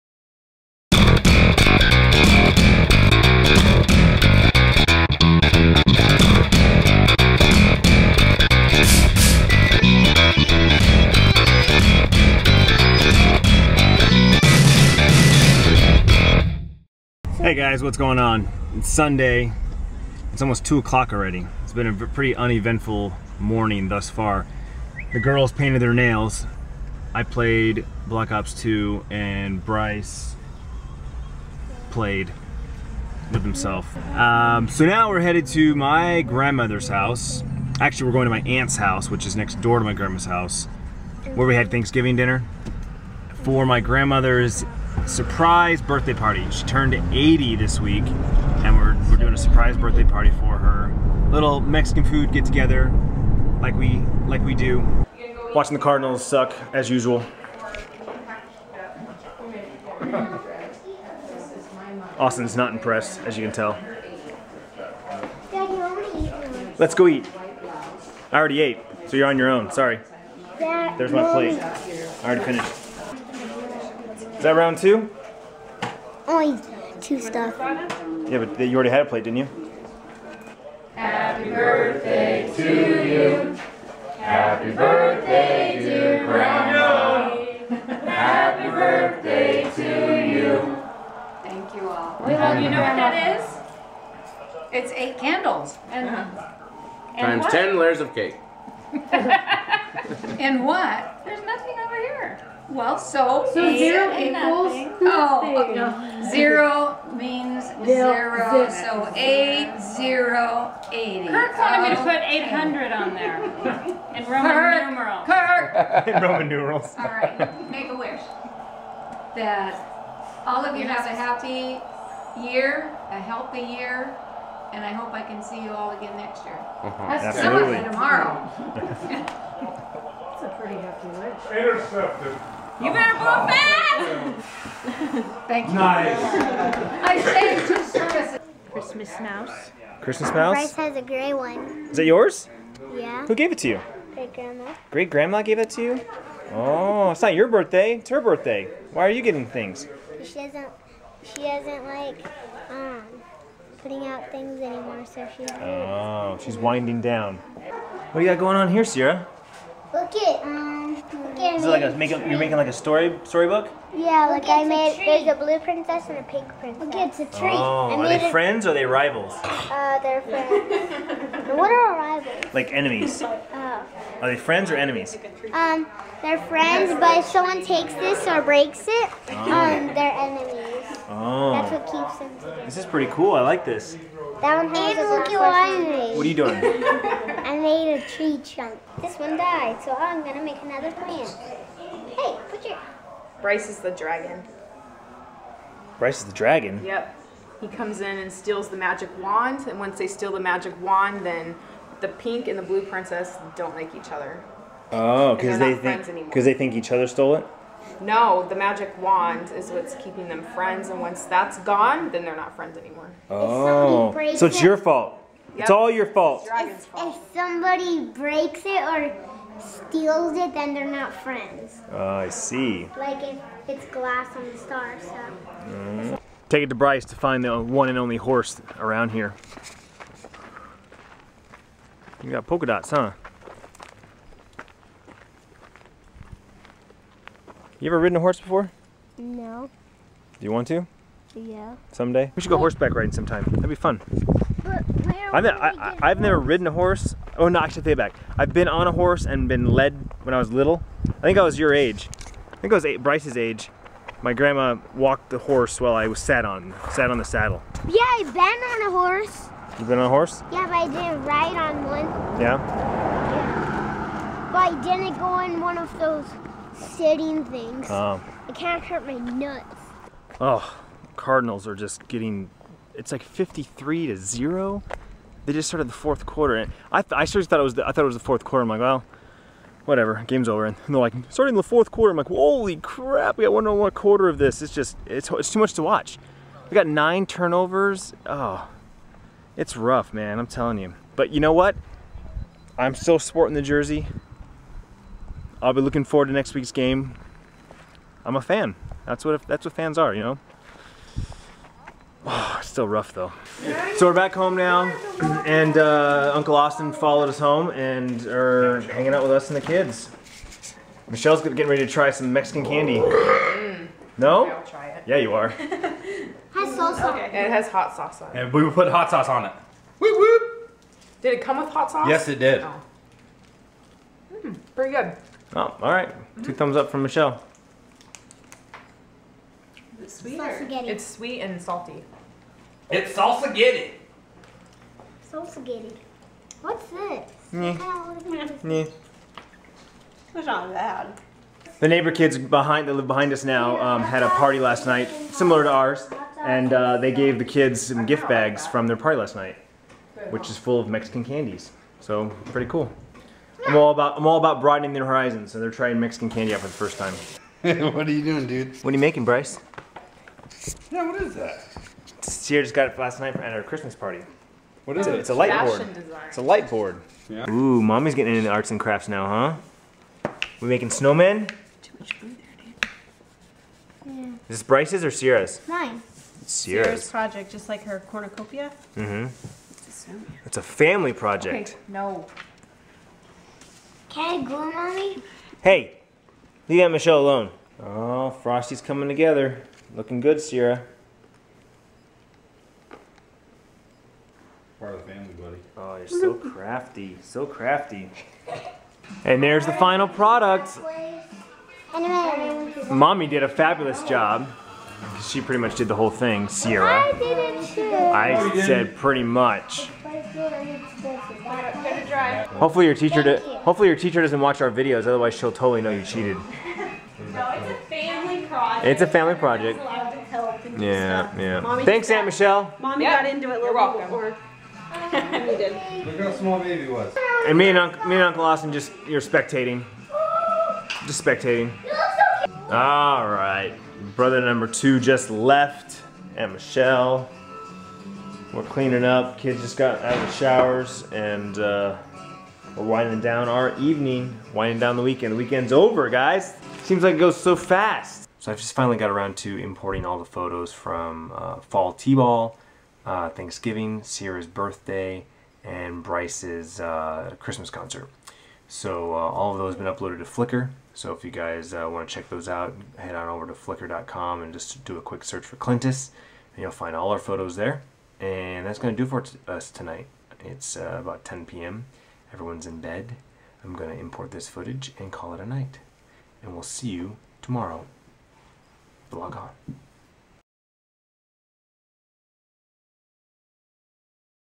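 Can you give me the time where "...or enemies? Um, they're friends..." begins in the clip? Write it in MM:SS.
02:54.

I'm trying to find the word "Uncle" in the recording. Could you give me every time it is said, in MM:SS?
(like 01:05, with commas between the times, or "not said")
05:06, 07:08.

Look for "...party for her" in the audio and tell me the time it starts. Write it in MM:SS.
00:50.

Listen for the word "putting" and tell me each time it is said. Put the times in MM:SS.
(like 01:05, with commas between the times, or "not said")
02:33.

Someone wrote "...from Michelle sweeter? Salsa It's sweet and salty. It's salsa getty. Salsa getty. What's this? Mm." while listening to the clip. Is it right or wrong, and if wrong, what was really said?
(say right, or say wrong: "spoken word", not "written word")
right.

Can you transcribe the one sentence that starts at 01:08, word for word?
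I already ate, so you're on your own.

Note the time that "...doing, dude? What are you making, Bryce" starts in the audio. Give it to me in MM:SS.
05:58.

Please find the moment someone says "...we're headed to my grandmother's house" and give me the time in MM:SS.
00:35.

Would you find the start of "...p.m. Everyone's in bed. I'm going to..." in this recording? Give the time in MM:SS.
07:51.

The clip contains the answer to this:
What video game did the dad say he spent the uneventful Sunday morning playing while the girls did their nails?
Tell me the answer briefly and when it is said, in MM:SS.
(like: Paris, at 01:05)
Black Ops 2, at 00:28.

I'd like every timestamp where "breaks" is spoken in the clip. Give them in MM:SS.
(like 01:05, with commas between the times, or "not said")
02:58, 03:38.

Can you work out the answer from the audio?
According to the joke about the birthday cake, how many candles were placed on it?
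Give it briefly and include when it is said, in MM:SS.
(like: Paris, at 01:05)
8, at 01:34.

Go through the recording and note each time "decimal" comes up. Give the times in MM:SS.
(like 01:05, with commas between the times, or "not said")
not said.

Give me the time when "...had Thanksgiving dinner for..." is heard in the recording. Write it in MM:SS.
00:41.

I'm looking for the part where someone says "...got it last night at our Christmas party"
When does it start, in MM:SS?
06:02.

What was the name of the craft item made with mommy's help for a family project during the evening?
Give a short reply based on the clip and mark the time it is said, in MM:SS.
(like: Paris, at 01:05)
Frosty, at 06:28.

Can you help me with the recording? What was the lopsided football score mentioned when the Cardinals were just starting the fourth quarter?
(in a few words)
53 to 0.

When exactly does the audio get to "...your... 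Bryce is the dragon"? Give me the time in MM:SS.
03:12.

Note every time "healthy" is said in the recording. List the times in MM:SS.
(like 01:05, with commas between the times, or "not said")
02:03.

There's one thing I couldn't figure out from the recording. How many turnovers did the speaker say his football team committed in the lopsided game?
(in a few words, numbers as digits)
9.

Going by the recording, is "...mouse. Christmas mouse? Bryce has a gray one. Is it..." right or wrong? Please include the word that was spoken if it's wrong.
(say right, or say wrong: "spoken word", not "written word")
right.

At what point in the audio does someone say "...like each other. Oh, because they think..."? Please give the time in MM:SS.
03:23.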